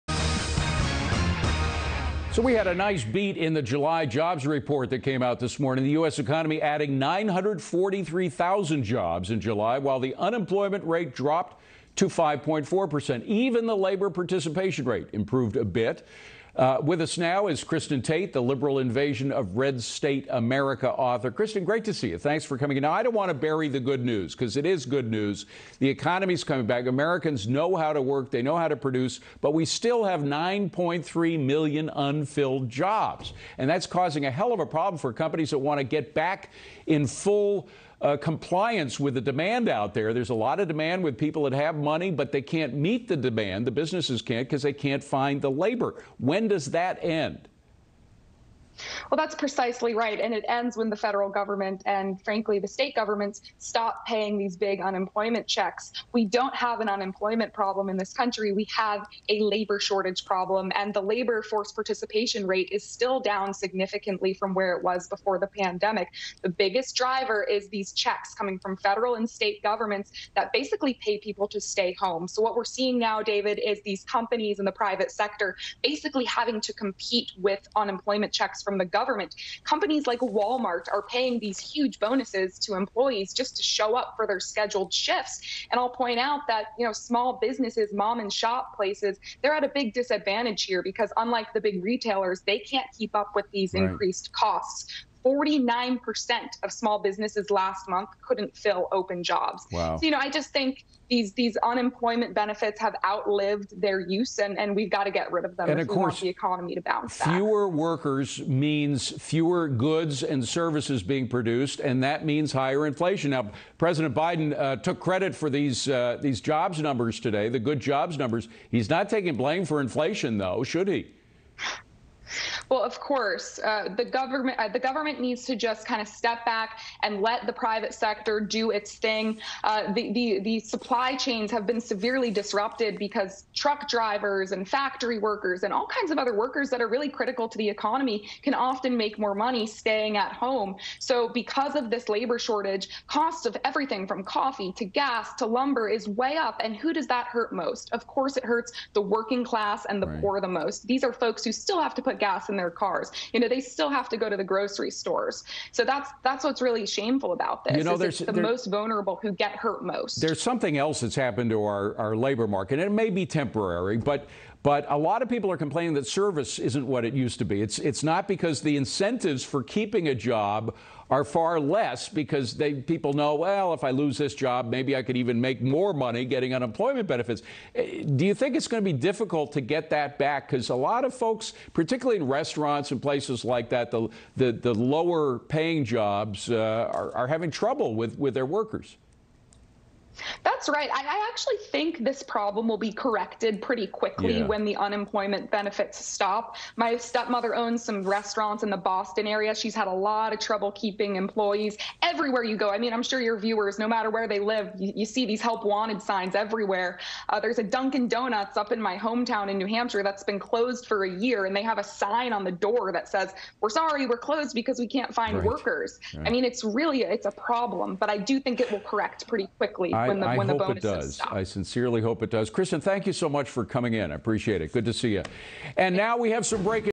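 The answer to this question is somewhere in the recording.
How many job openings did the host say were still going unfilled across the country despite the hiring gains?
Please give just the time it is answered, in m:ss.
0:30.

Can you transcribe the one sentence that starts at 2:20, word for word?
So because of this labor shortage, cost of everything from coffee to gas to lumber is way up.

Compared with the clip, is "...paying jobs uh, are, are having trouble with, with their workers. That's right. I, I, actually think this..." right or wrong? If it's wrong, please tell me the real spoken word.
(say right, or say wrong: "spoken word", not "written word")
right.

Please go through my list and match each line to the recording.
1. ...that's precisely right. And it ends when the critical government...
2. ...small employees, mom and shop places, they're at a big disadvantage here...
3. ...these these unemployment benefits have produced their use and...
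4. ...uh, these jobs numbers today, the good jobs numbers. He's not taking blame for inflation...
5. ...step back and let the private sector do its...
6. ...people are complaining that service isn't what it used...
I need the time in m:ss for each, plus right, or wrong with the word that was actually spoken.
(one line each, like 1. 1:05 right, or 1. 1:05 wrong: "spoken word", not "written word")
1. 0:49 wrong: "federal", not "critical"
2. 1:26 wrong: "businesses", not "employees"
3. 1:41 wrong: "outlived", not "produced"
4. 1:55 right
5. 2:06 right
6. 2:45 right.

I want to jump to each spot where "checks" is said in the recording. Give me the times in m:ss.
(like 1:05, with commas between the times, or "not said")
0:55, 1:07, 1:18.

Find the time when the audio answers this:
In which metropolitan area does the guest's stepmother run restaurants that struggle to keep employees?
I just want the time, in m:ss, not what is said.
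3:18.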